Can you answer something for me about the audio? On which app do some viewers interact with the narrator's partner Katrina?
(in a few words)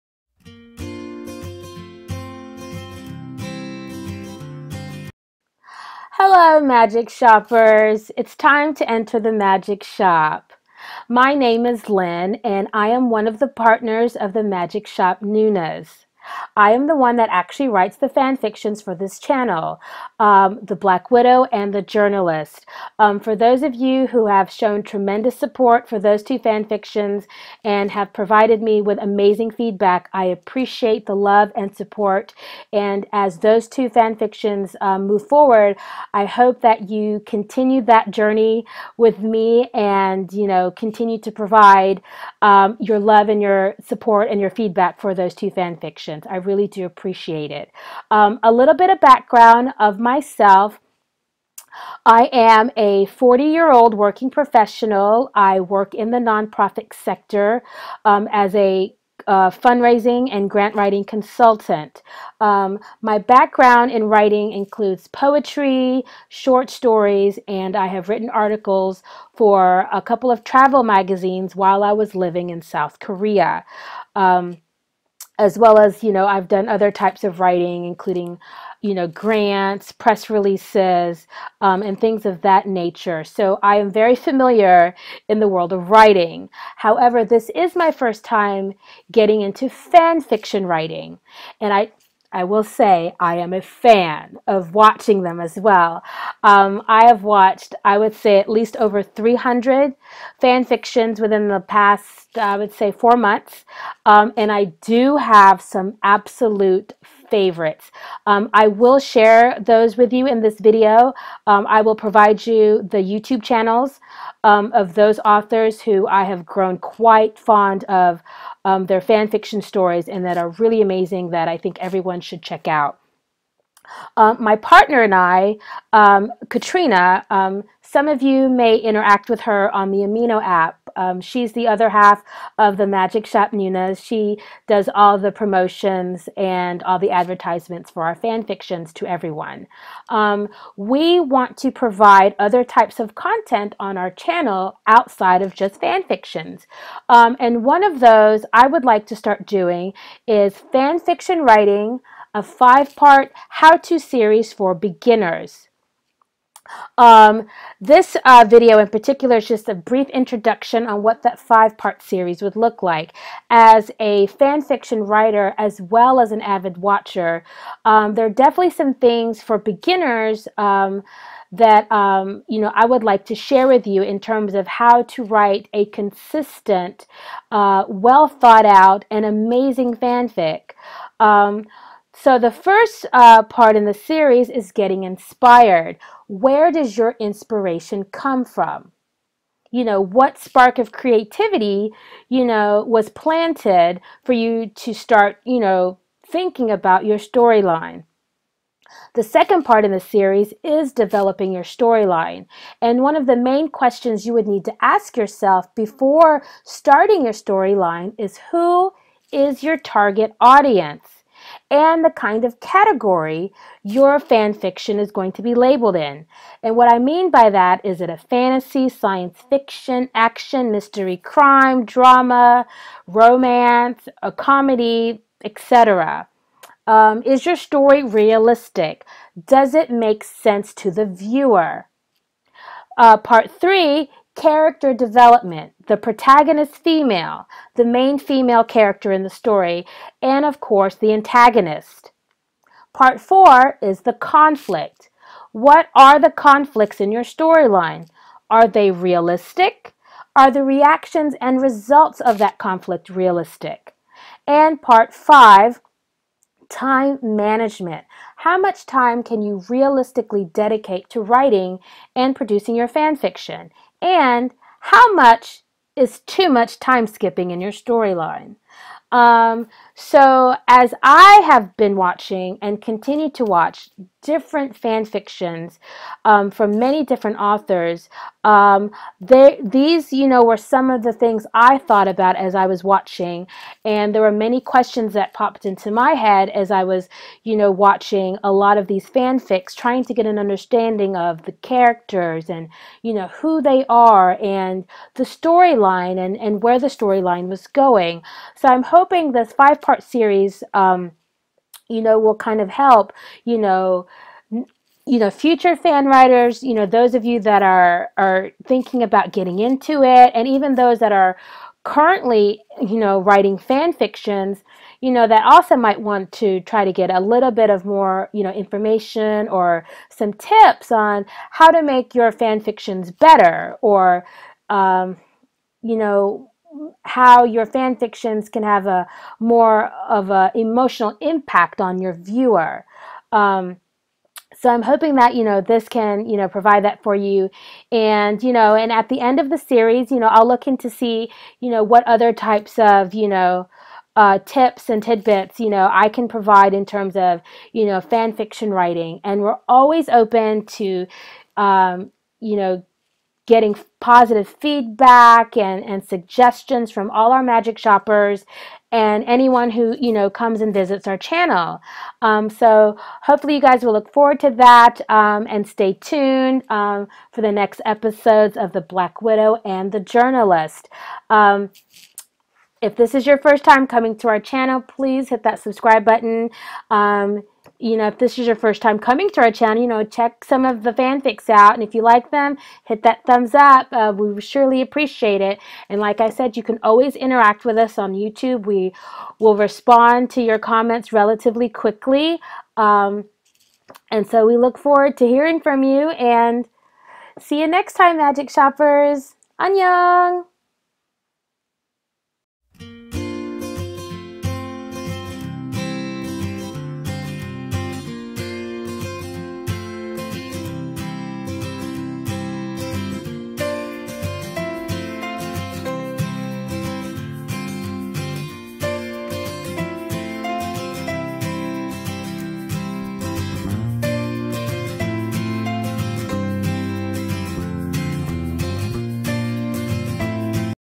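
Amino.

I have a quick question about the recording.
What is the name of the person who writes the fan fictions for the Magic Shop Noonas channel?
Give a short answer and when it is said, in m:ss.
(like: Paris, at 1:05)
Lynn, at 0:11.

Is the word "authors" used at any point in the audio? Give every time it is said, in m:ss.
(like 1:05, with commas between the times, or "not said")
1:55, 4:37.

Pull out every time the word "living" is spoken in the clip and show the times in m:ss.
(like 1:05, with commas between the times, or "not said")
1:12.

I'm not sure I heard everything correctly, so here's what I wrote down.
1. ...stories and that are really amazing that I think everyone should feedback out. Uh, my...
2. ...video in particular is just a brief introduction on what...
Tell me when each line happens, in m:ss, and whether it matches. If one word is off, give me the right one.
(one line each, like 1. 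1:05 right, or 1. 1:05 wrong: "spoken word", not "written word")
1. 1:59 wrong: "check", not "feedback"
2. 2:38 right.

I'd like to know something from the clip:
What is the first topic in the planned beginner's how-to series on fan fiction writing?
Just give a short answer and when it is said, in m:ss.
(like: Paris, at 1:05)
Getting inspired, at 3:04.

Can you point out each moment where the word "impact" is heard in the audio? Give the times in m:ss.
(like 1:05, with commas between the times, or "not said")
5:31.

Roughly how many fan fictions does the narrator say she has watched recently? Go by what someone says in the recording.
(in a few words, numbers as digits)
300.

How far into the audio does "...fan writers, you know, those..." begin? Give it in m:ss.
5:05.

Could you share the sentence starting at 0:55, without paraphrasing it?
I work in the nonprofit sector um, as a uh, fundraising and grant writing consultant.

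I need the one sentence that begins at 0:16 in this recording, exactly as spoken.
I am the one that actually writes the fan fictions for this channel, um, The Black Widow and The Journalist.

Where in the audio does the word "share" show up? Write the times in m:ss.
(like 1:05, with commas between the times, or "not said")
1:48, 2:53.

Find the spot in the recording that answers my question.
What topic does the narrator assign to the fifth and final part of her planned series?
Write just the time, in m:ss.
4:16.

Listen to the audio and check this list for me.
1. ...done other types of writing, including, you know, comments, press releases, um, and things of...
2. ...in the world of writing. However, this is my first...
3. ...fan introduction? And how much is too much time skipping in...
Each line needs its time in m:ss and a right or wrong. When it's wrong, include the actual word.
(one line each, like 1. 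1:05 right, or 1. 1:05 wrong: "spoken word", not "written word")
1. 1:16 wrong: "grants", not "comments"
2. 1:25 right
3. 4:22 wrong: "fiction", not "introduction".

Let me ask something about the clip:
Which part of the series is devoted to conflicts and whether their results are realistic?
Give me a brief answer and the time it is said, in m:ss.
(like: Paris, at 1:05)
Part four, at 4:02.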